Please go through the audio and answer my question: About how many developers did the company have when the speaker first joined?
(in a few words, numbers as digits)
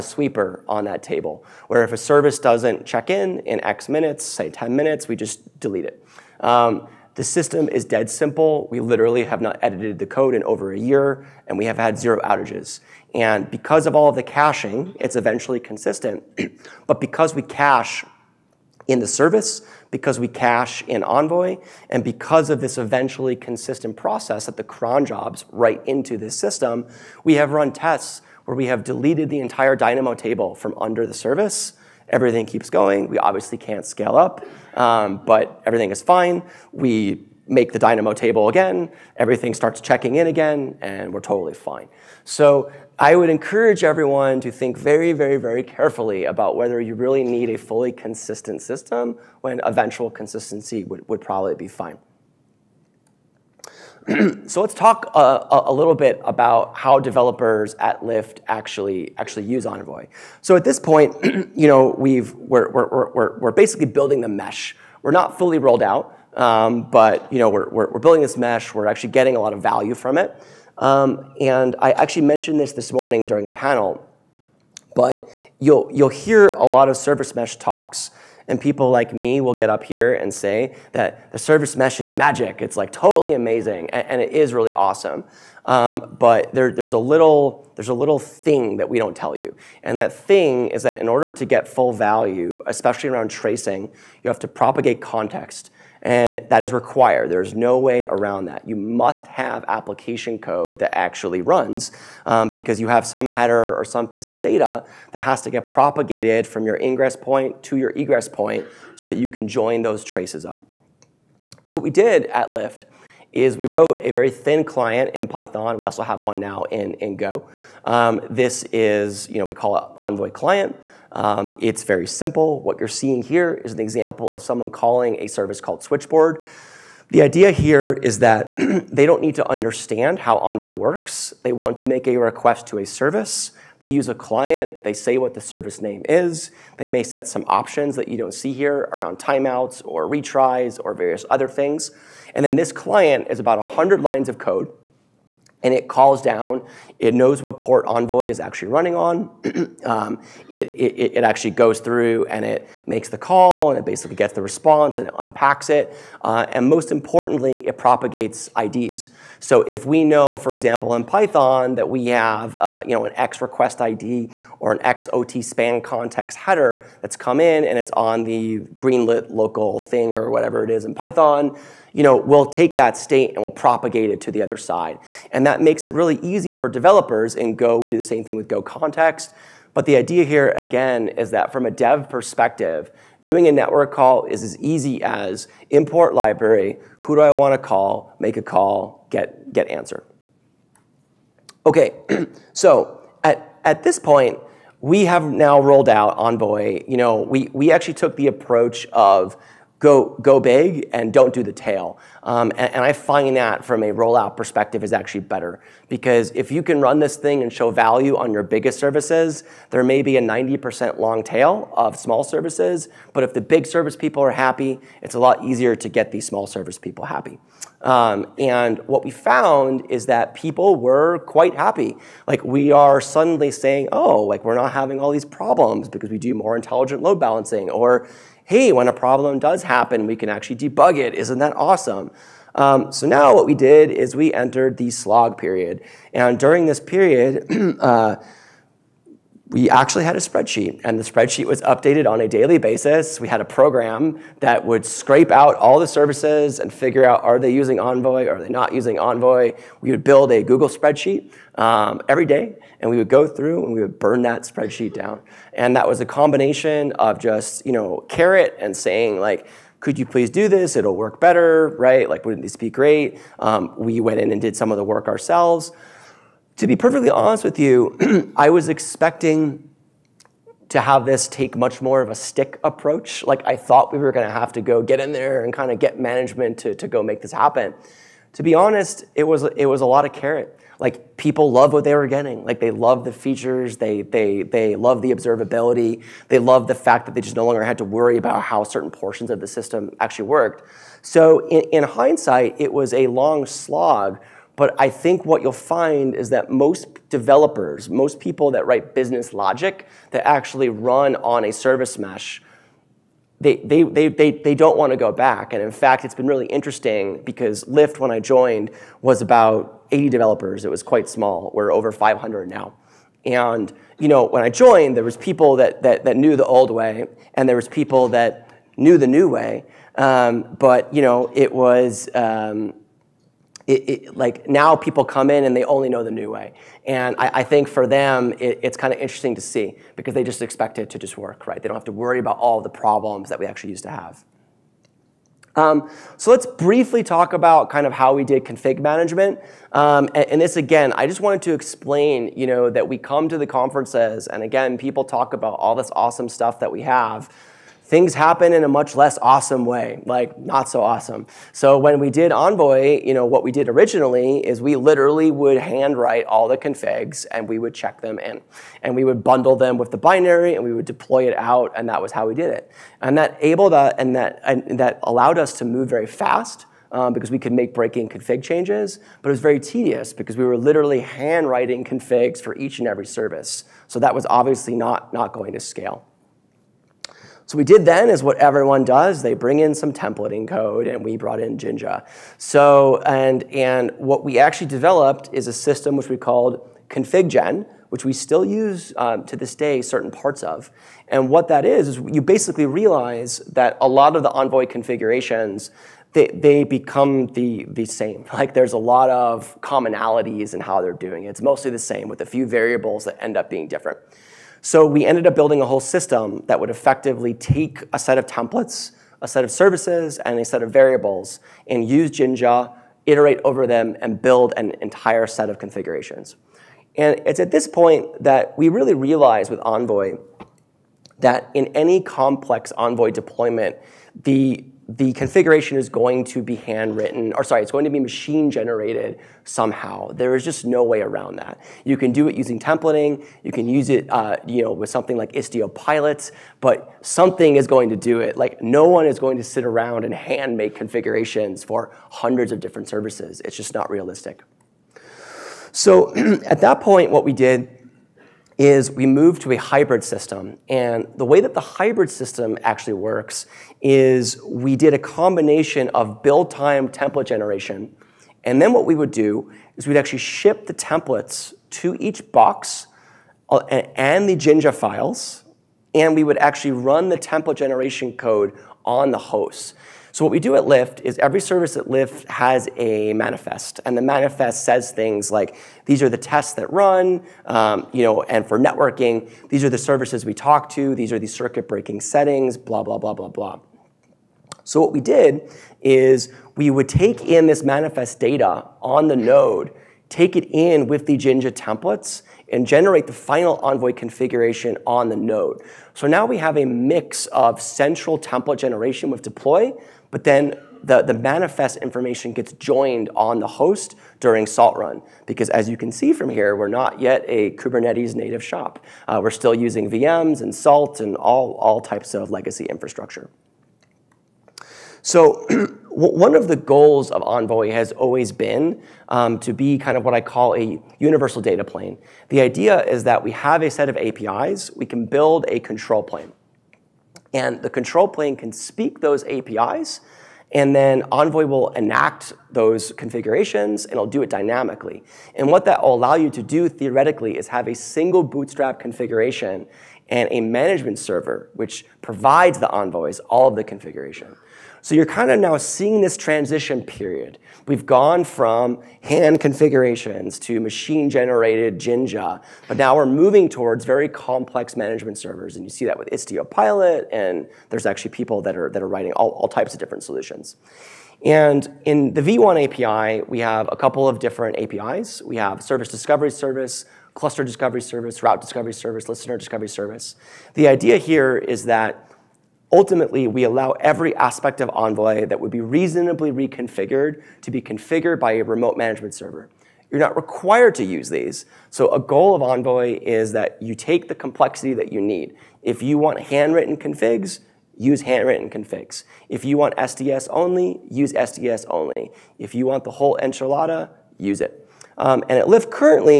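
80.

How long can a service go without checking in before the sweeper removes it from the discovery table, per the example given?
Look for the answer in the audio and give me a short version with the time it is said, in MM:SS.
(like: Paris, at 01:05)
10 minutes, at 00:04.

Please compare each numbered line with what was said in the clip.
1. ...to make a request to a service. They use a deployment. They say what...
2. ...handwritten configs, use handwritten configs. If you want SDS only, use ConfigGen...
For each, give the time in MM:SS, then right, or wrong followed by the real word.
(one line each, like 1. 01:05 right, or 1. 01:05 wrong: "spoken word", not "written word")
1. 02:11 wrong: "client", not "deployment"
2. 09:46 wrong: "SDS", not "ConfigGen".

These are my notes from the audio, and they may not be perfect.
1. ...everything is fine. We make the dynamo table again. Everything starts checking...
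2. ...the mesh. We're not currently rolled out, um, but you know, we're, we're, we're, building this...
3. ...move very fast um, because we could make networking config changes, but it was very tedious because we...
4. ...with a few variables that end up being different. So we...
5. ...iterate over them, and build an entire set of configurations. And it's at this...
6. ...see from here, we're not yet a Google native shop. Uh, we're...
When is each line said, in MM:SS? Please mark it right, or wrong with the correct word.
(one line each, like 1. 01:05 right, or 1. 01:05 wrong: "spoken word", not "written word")
1. 00:35 right
2. 01:04 wrong: "fully", not "currently"
3. 06:05 wrong: "breaking", not "networking"
4. 06:42 right
5. 06:53 right
6. 08:25 wrong: "Kubernetes", not "Google".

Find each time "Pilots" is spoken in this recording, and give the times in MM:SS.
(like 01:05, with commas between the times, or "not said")
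07:15, 09:16.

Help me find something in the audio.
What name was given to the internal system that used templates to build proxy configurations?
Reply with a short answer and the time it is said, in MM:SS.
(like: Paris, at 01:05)
ConfigGen, at 06:26.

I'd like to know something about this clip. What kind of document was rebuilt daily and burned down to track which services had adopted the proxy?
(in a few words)
Google spreadsheet.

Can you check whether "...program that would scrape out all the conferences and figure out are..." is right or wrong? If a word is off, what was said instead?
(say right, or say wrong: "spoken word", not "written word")
wrong: "services", not "conferences".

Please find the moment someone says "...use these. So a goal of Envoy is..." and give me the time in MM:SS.
09:40.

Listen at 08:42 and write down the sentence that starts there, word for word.
The idea is that we have a set of APIs, we can build a control plane.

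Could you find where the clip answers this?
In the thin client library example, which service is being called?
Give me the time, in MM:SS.
02:05.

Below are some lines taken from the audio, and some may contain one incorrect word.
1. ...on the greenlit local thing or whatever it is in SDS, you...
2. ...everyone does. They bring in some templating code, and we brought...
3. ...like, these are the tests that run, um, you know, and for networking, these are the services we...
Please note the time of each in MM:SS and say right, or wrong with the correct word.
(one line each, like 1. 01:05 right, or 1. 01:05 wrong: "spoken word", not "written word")
1. 02:47 wrong: "Python", not "SDS"
2. 06:18 right
3. 07:55 right.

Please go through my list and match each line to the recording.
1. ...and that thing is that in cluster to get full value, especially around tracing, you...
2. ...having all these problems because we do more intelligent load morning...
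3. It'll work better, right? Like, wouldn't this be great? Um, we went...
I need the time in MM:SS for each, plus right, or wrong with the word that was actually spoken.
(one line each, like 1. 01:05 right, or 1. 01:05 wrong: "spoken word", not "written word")
1. 01:29 wrong: "order", not "cluster"
2. 03:44 wrong: "balancing", not "morning"
3. 04:20 right.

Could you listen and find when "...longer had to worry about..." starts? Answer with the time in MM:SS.
04:47.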